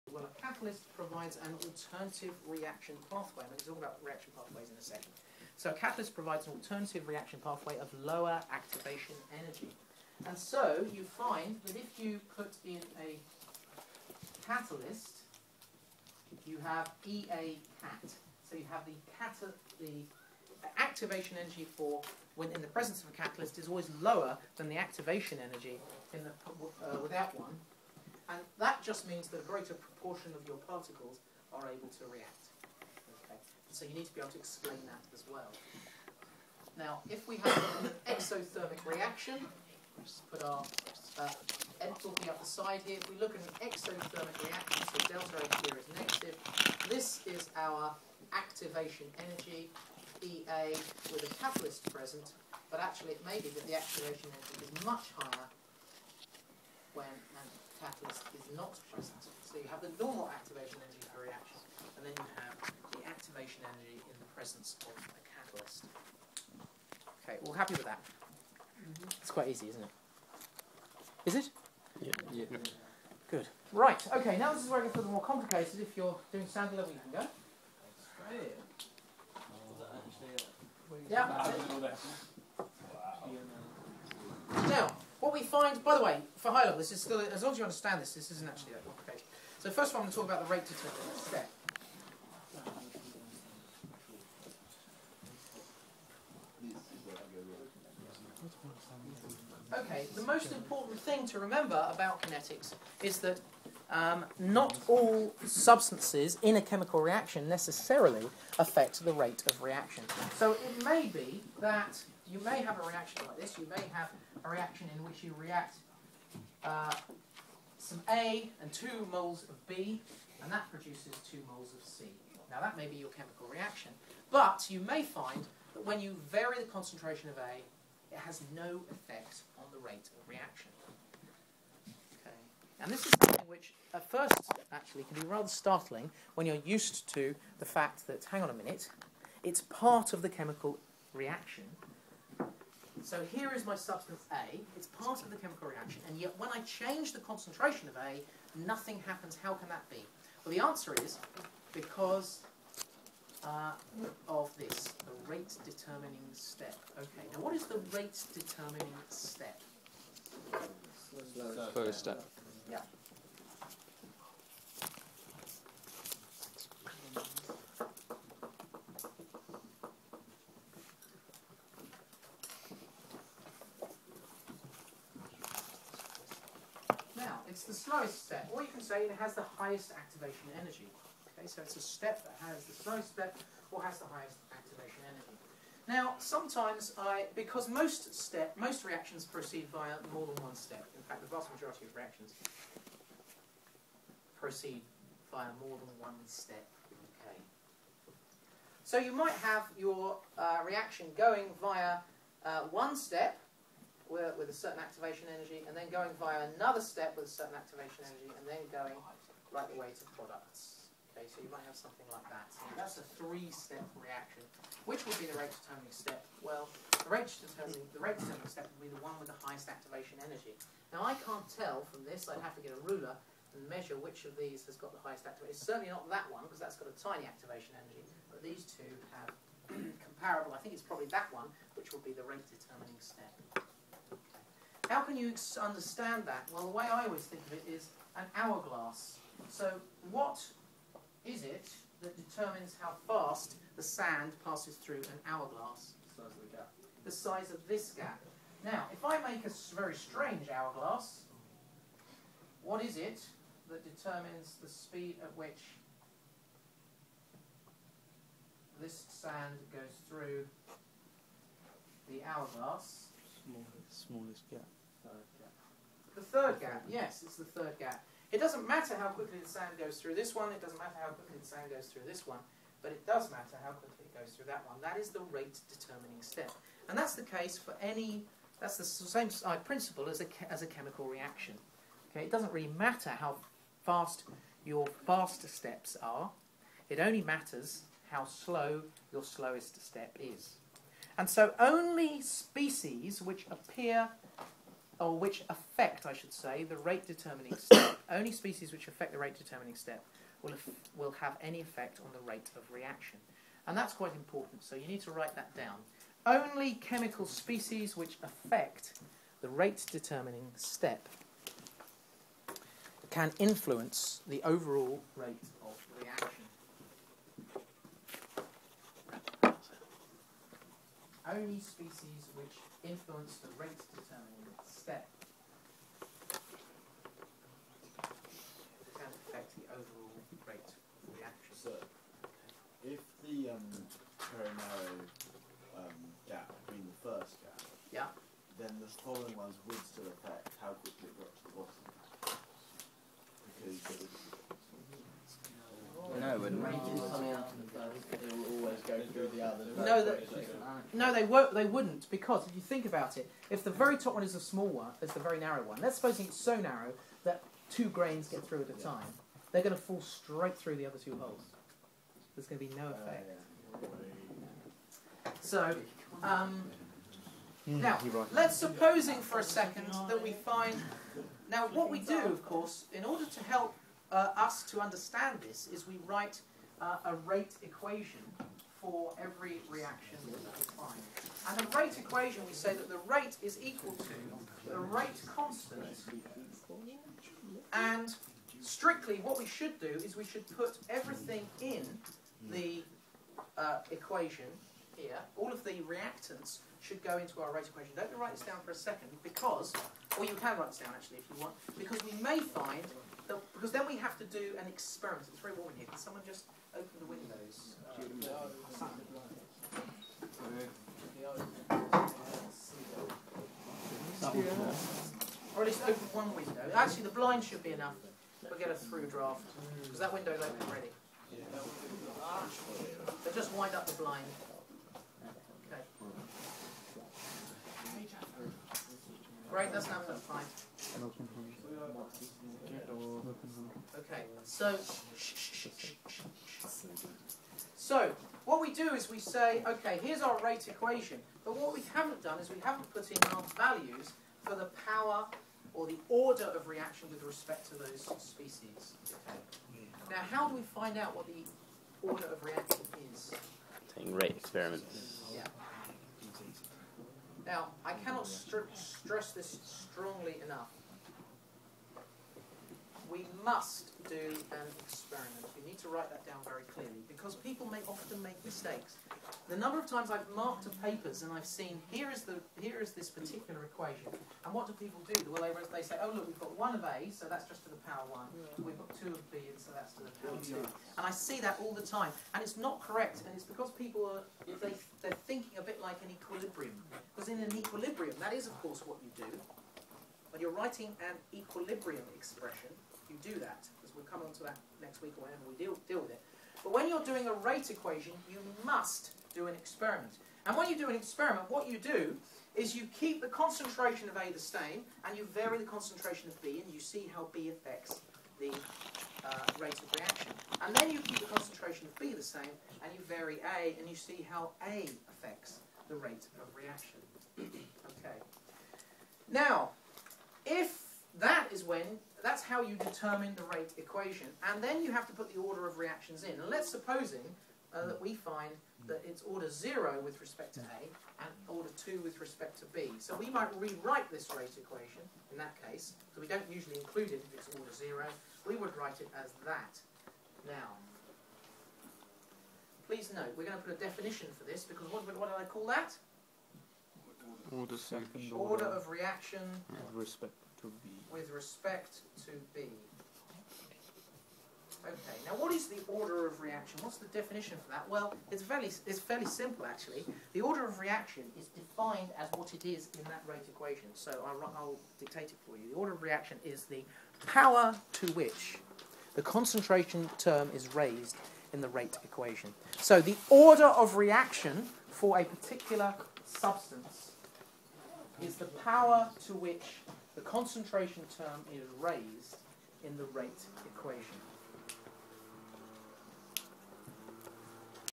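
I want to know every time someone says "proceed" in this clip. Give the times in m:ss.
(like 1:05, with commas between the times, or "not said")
3:09, 3:14.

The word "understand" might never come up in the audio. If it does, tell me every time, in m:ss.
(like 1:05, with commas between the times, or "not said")
1:27, 3:55, 6:14.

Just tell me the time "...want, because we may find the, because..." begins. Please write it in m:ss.
6:41.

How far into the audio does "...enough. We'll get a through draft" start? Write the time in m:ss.
6:57.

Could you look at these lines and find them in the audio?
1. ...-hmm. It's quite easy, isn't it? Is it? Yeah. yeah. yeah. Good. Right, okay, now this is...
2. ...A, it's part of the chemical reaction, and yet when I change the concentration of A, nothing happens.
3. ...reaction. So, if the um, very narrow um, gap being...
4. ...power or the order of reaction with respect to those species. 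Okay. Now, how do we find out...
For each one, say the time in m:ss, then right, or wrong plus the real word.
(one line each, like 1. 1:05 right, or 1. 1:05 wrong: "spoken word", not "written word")
1. 1:08 right
2. 2:24 right
3. 5:31 right
4. 7:24 right.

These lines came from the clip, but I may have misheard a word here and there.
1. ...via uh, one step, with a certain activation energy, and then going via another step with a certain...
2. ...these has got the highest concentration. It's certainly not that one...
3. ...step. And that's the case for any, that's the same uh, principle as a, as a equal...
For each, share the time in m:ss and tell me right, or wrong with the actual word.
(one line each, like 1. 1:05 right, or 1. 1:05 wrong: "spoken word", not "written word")
1. 3:21 right
2. 3:44 wrong: "activation", not "concentration"
3. 4:36 wrong: "chemical", not "equal".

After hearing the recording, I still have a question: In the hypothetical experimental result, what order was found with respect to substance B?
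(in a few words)
2.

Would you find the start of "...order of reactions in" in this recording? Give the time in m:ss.
8:45.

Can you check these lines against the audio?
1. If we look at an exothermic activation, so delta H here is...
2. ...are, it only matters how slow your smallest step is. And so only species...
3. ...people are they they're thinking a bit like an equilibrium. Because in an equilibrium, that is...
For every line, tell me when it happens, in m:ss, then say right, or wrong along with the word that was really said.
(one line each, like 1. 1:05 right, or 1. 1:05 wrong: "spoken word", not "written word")
1. 0:43 wrong: "reaction", not "activation"
2. 4:46 wrong: "slowest", not "smallest"
3. 8:03 right.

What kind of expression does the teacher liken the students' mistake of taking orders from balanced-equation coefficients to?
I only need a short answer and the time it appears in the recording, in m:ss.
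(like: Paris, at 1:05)
An equilibrium expression, at 8:11.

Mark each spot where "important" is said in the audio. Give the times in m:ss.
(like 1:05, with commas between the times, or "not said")
1:40, 5:04.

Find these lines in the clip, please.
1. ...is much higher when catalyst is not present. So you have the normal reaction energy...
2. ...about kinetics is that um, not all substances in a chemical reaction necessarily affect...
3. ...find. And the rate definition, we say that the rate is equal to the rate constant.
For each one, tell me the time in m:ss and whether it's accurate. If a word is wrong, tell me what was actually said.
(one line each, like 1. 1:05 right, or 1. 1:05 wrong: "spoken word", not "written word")
1. 0:54 wrong: "activation", not "reaction"
2. 1:41 right
3. 6:20 wrong: "equation", not "definition".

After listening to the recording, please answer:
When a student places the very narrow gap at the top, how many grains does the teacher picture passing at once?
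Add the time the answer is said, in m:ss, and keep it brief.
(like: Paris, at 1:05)
Two grains, at 5:57.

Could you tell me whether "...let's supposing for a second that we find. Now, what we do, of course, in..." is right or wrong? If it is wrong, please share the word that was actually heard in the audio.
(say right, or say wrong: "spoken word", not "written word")
right.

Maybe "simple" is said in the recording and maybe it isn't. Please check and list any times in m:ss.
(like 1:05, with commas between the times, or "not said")
9:19.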